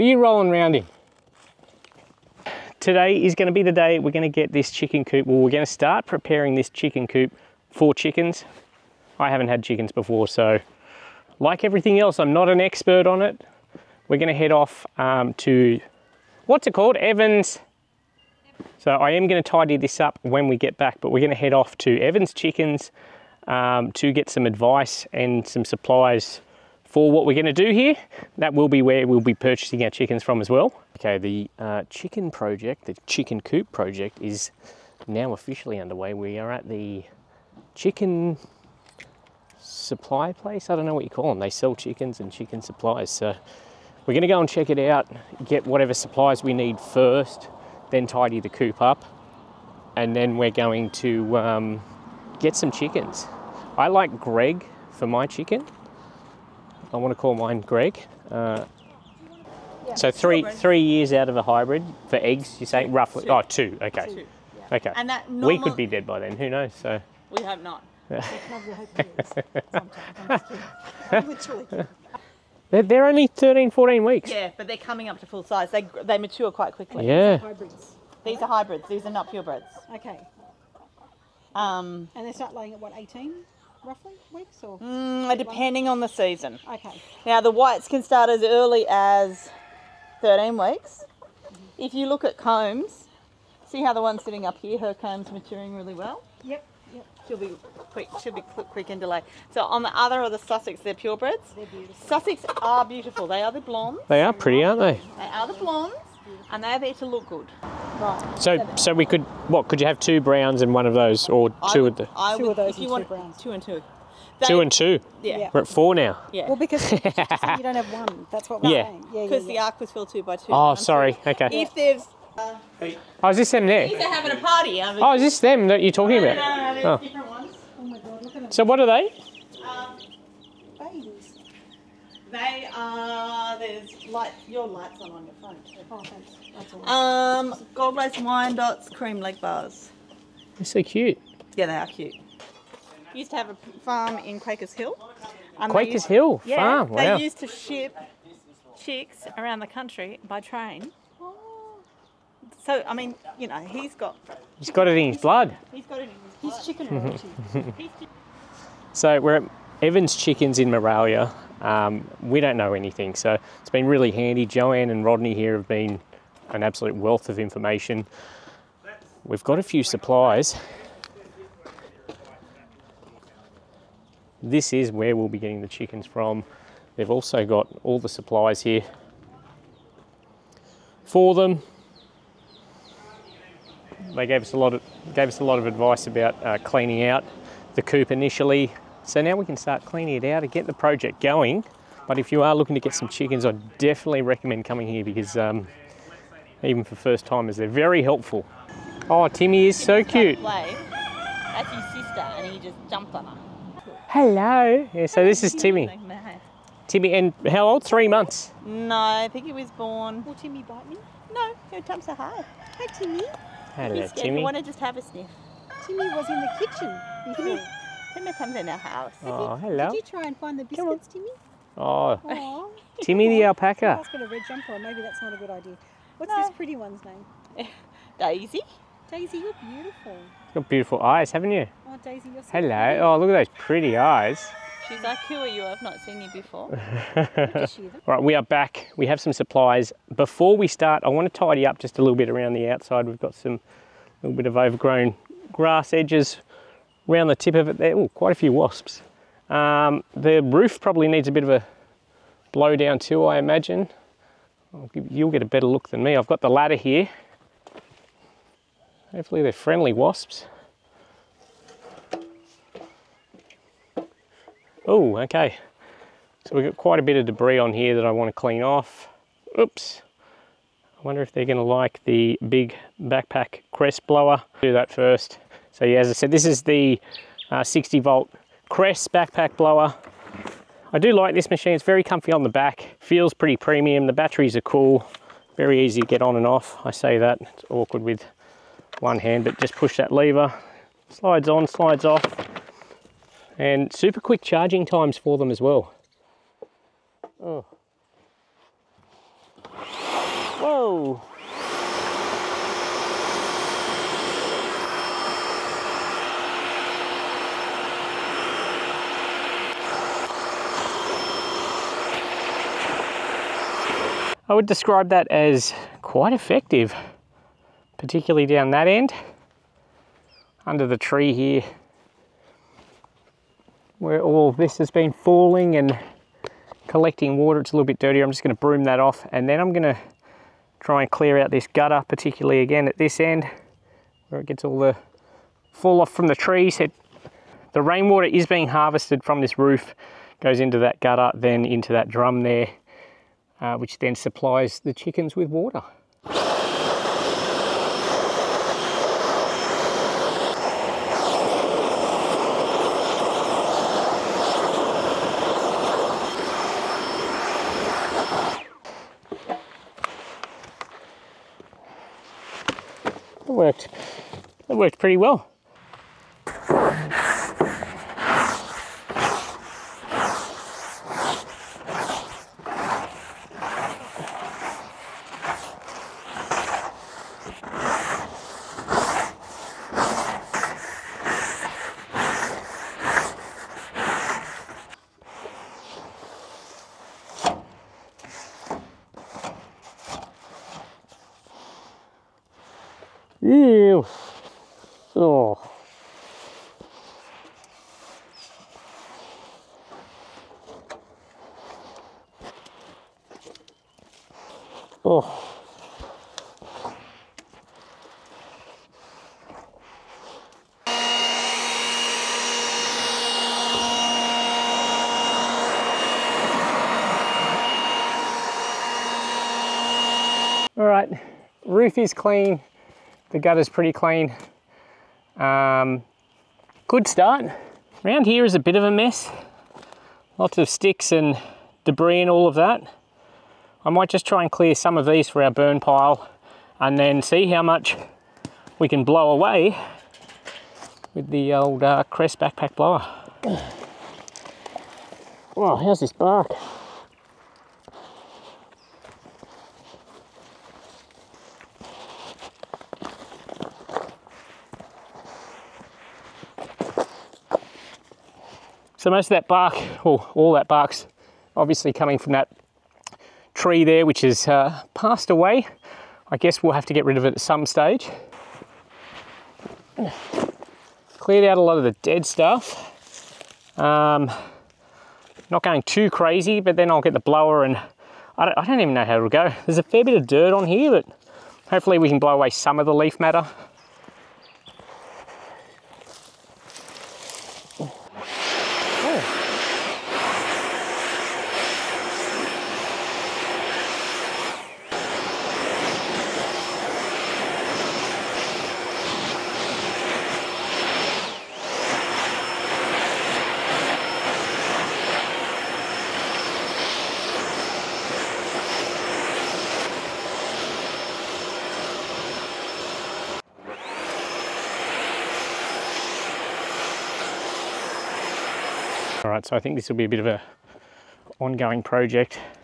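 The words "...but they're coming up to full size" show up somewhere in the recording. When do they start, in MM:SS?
01:14.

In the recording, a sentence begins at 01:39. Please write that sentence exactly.
So on the other are the Sussex.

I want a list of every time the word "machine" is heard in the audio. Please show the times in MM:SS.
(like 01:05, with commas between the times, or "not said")
04:41.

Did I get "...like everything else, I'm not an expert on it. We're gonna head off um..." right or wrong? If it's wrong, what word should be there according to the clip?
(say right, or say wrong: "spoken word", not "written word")
right.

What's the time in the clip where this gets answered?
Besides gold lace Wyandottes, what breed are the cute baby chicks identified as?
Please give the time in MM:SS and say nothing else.
02:18.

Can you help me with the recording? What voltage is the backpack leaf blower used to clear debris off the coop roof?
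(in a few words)
60 volt.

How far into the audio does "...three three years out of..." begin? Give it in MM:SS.
01:00.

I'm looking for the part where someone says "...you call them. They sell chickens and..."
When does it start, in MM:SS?
00:41.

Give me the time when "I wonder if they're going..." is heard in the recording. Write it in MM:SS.
04:30.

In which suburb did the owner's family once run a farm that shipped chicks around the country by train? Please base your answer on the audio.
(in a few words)
Quakers Hill.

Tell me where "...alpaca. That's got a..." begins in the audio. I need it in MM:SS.
03:43.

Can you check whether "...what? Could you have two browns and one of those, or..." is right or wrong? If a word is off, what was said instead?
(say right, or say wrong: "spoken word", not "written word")
right.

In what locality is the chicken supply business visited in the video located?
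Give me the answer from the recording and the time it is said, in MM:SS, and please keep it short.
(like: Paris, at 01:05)
Maraylya, at 02:40.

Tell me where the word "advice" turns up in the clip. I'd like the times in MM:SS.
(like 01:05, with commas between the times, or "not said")
00:24, 03:05.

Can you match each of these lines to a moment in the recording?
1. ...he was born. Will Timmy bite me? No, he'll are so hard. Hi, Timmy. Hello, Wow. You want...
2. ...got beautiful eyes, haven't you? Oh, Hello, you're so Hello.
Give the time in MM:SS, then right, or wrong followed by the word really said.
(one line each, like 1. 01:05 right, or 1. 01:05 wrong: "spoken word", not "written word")
1. 03:29 wrong: "Timmy", not "Wow"
2. 03:50 wrong: "Daisy", not "Hello".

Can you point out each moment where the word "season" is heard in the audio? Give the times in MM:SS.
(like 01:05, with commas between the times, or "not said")
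01:26.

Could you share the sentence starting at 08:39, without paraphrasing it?
So I think this will be a bit of a ongoing project.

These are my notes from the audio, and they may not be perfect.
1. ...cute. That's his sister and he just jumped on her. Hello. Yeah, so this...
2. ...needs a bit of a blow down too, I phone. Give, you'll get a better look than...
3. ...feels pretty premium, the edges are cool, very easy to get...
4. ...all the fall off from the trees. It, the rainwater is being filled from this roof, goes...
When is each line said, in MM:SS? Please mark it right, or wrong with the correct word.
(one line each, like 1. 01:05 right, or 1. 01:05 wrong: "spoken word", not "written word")
1. 03:20 right
2. 04:11 wrong: "imagine", not "phone"
3. 04:42 wrong: "batteries", not "edges"
4. 05:34 wrong: "harvested", not "filled".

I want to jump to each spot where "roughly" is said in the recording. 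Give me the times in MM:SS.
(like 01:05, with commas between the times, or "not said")
01:02, 01:23.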